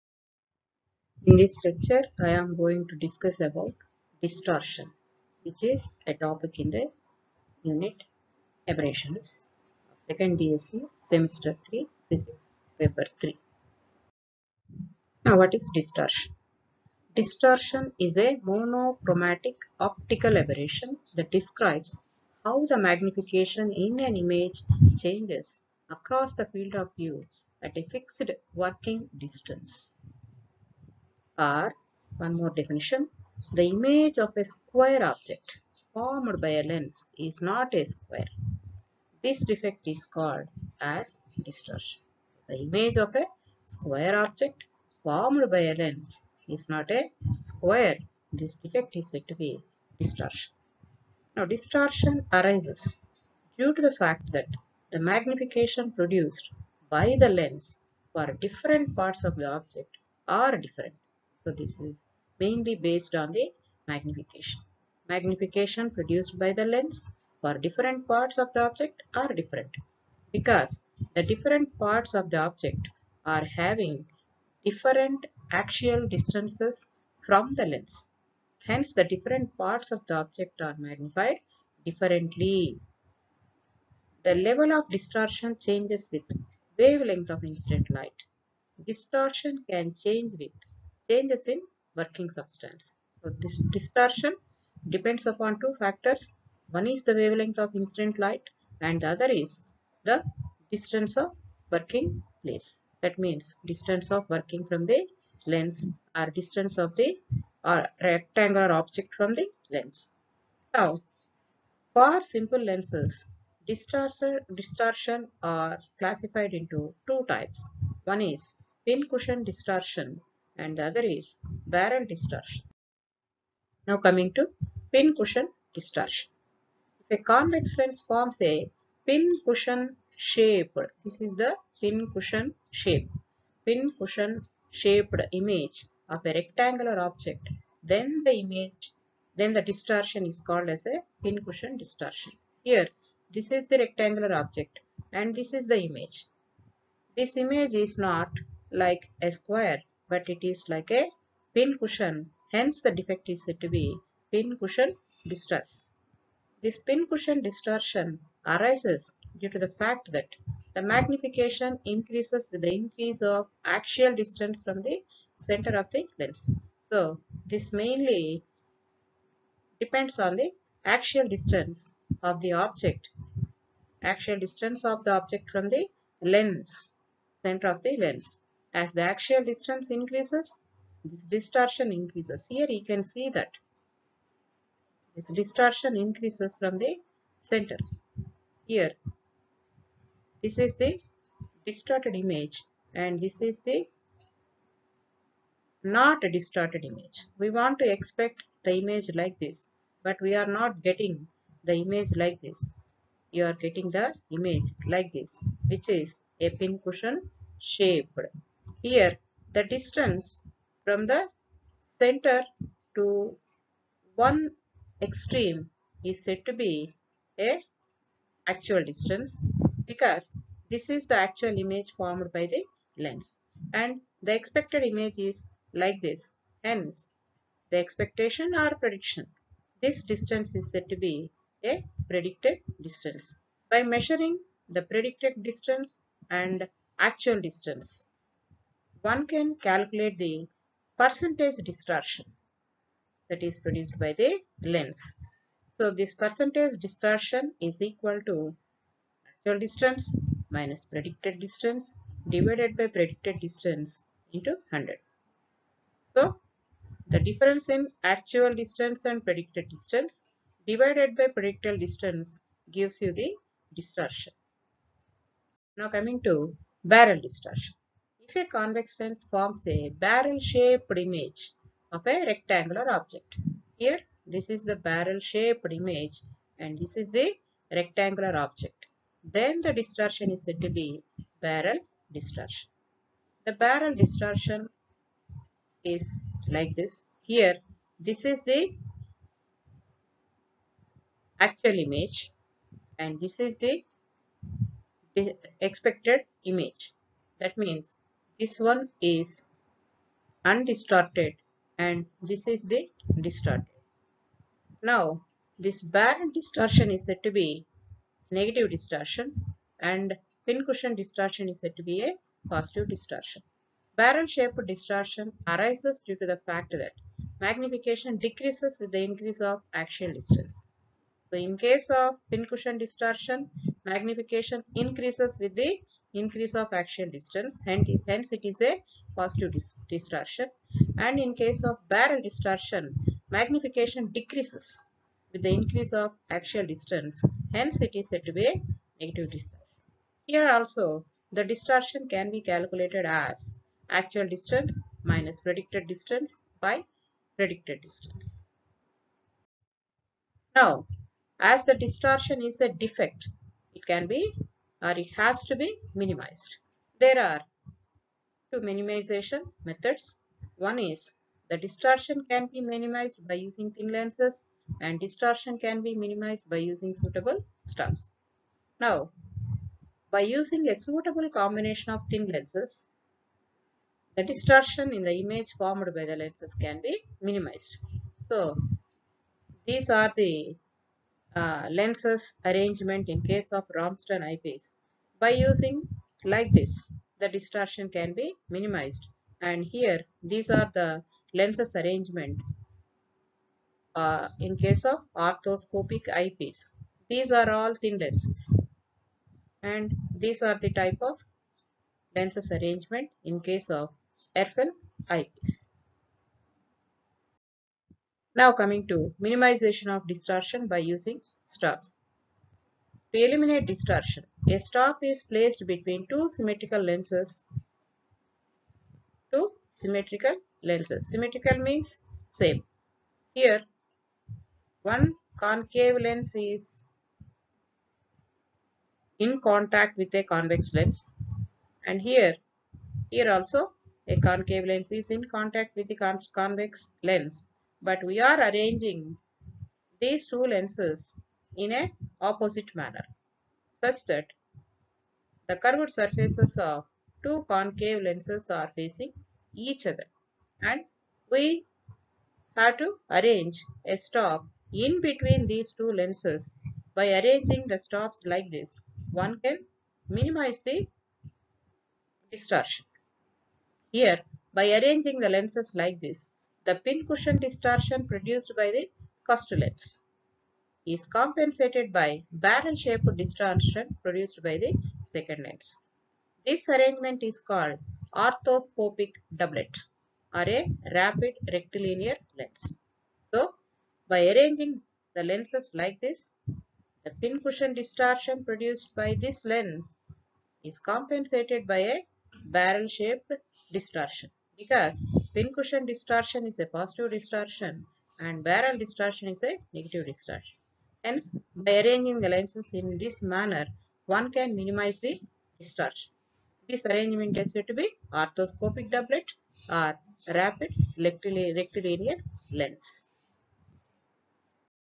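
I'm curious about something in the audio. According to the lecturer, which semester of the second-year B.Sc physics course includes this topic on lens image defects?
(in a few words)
Semester 3.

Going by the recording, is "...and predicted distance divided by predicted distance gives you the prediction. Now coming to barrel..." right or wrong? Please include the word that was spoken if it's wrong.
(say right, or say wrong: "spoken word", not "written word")
wrong: "distortion", not "prediction".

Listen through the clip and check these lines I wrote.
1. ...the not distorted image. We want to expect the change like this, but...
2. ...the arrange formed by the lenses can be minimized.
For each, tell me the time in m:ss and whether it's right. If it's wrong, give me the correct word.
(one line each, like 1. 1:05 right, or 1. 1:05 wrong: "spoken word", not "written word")
1. 3:13 wrong: "image", not "change"
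2. 6:15 wrong: "image", not "arrange".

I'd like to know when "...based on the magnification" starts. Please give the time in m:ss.
1:02.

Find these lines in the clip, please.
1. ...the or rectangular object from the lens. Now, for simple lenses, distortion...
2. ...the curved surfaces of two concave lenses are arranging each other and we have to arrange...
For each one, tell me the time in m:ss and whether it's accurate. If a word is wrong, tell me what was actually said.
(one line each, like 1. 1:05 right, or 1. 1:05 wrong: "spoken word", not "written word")
1. 1:46 right
2. 7:25 wrong: "facing", not "arranging".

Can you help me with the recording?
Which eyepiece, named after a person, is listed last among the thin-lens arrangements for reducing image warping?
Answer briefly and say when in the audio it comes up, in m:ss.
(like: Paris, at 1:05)
Erfle eyepiece, at 6:44.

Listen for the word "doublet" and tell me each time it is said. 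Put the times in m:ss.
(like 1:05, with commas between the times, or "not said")
7:59, 8:28.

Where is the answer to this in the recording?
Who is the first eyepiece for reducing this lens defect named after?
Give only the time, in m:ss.
6:23.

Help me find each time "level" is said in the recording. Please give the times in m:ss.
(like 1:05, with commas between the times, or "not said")
1:24.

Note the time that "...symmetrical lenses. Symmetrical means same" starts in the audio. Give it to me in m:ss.
6:59.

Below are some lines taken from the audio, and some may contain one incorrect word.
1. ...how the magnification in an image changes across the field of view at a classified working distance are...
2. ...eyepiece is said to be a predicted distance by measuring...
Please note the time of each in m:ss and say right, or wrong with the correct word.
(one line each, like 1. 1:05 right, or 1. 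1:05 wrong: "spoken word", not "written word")
1. 0:22 wrong: "fixed", not "classified"
2. 3:50 wrong: "distance", not "eyepiece".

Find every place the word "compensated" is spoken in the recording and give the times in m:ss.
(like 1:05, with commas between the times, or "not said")
7:51, 8:10.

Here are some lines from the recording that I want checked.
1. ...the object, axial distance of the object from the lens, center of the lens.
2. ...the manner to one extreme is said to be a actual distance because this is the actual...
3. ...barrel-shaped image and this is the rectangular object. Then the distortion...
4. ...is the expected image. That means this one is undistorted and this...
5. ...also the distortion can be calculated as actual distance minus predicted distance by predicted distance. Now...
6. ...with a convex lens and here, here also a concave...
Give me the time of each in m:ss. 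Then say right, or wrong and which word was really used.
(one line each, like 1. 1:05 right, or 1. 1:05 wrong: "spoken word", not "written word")
1. 2:52 right
2. 3:31 wrong: "center", not "manner"
3. 4:34 right
4. 4:53 right
5. 5:40 right
6. 7:09 right.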